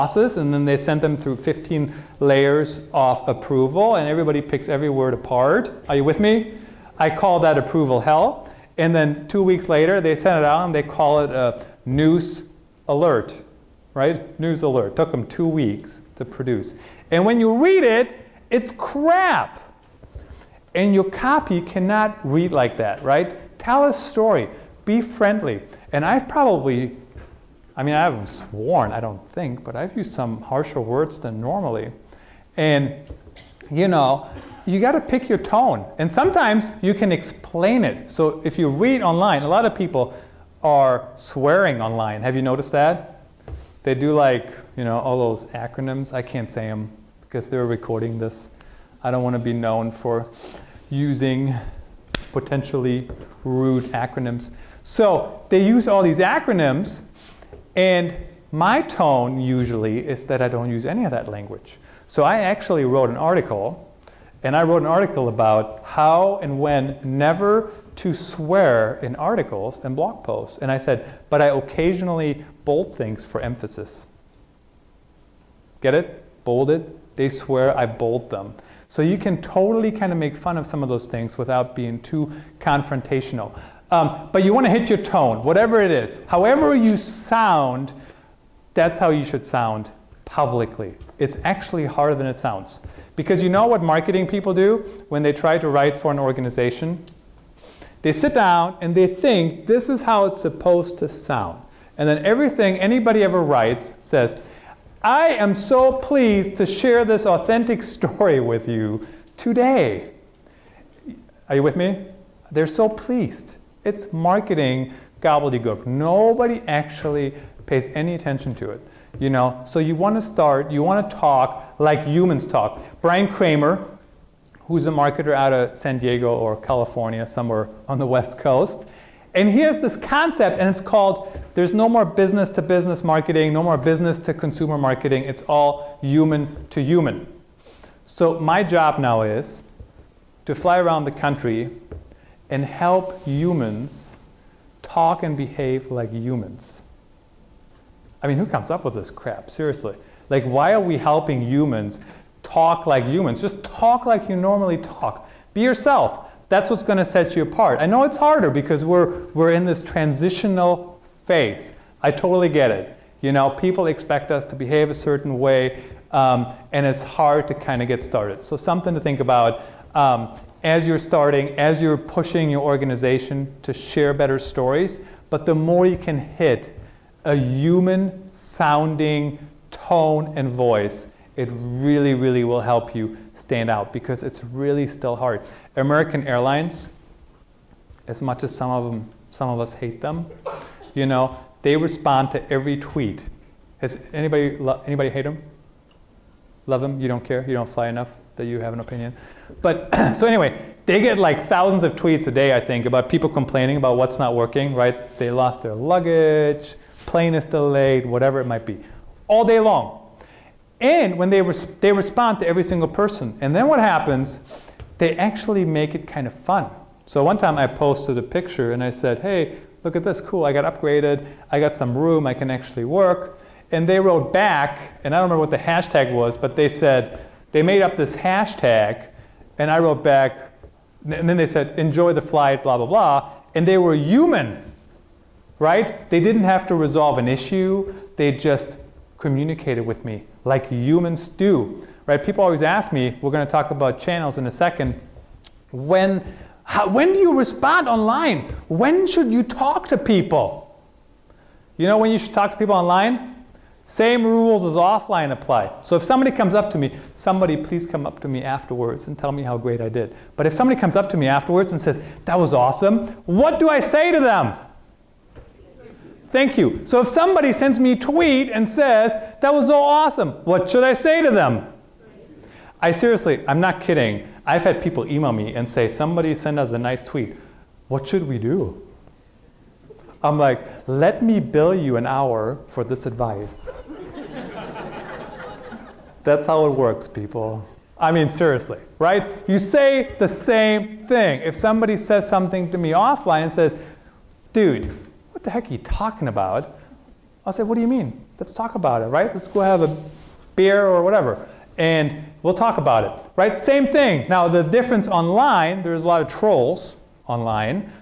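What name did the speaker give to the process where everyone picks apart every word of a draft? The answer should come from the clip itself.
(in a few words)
approval hell.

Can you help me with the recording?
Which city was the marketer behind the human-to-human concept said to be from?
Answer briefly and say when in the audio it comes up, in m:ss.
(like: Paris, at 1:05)
San Diego, at 2:05.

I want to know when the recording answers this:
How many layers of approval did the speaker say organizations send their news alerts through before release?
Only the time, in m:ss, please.
0:01.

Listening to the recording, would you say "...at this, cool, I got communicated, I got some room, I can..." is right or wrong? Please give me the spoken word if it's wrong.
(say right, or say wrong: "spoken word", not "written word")
wrong: "upgraded", not "communicated".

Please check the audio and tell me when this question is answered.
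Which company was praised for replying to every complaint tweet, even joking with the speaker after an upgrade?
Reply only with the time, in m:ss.
3:05.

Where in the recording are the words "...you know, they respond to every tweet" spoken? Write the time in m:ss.
3:10.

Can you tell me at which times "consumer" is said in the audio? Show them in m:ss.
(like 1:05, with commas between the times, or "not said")
2:14.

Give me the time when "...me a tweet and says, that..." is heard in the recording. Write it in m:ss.
4:27.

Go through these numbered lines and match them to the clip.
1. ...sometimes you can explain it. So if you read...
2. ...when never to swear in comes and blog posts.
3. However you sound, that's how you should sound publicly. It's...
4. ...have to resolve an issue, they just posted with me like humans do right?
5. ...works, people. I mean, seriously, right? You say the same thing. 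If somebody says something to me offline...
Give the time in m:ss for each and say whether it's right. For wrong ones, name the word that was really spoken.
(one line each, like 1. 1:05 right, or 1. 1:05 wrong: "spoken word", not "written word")
1. 0:36 right
2. 1:06 wrong: "articles", not "comes"
3. 1:26 right
4. 3:56 wrong: "communicated", not "posted"
5. 4:46 right.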